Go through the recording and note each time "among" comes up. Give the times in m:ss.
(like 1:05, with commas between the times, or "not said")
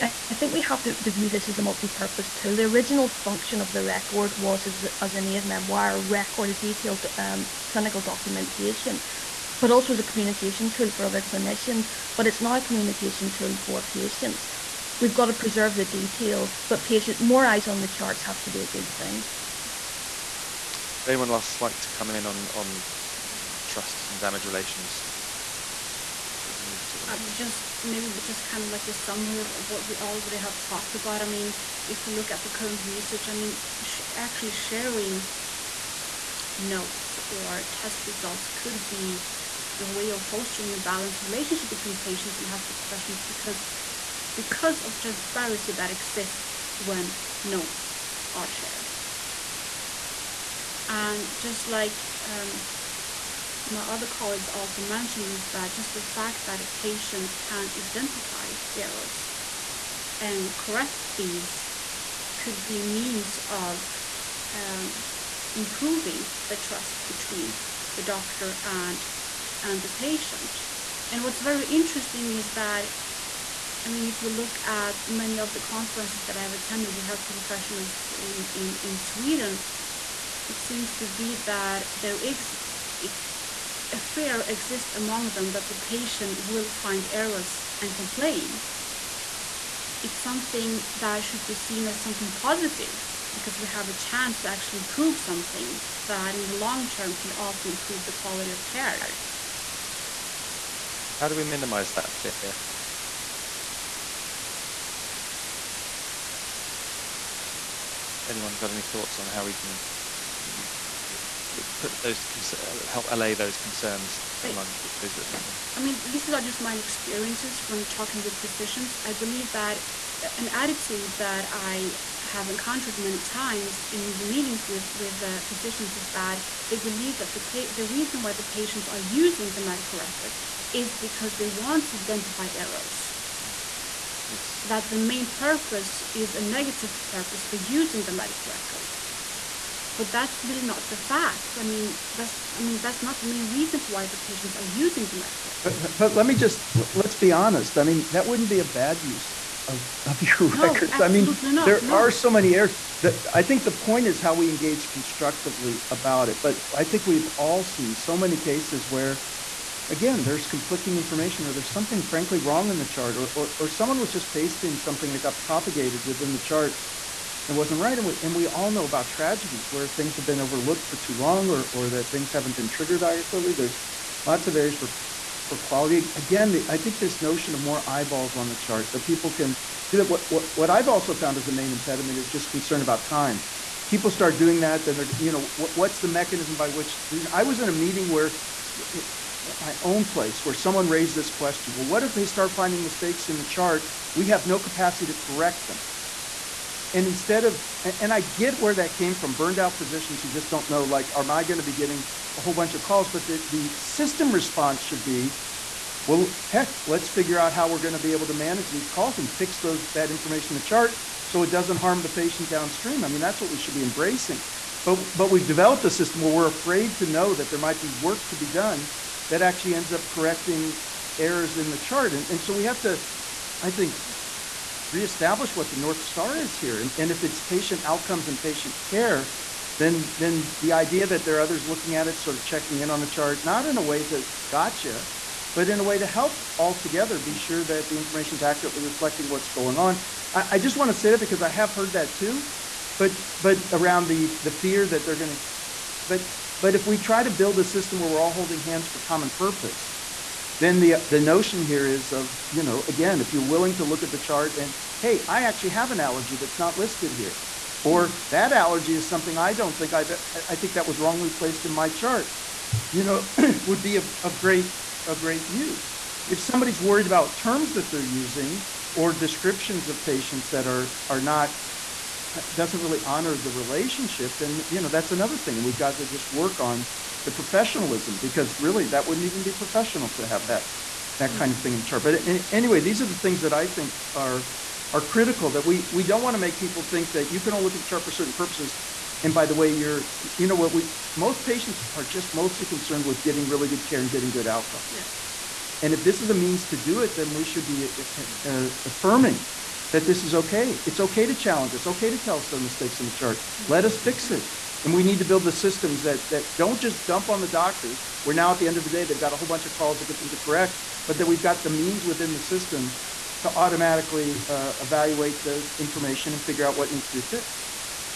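1:24, 1:54.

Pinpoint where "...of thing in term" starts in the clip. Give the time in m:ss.
4:41.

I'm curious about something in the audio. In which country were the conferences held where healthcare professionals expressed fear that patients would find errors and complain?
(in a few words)
Sweden.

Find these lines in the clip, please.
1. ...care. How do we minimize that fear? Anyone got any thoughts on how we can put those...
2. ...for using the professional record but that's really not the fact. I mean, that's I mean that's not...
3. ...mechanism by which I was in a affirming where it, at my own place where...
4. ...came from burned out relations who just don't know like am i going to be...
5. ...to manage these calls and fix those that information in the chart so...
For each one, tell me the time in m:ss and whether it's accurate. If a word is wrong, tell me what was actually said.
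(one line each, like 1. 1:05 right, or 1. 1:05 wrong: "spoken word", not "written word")
1. 1:38 right
2. 2:17 wrong: "medical", not "professional"
3. 3:06 wrong: "meeting", not "affirming"
4. 3:18 wrong: "physicians", not "relations"
5. 3:28 right.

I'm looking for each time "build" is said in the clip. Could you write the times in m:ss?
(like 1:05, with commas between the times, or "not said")
4:07, 5:05.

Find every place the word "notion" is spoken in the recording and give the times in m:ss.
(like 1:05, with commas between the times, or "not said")
2:57, 4:11.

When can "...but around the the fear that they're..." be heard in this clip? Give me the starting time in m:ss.
4:03.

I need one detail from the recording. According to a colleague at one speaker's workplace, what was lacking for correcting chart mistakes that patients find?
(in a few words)
capacity.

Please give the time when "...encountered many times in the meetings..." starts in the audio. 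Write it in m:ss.
2:02.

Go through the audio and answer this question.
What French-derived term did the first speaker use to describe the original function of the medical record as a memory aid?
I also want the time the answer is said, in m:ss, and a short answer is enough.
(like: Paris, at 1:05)
aide-memoire, at 0:05.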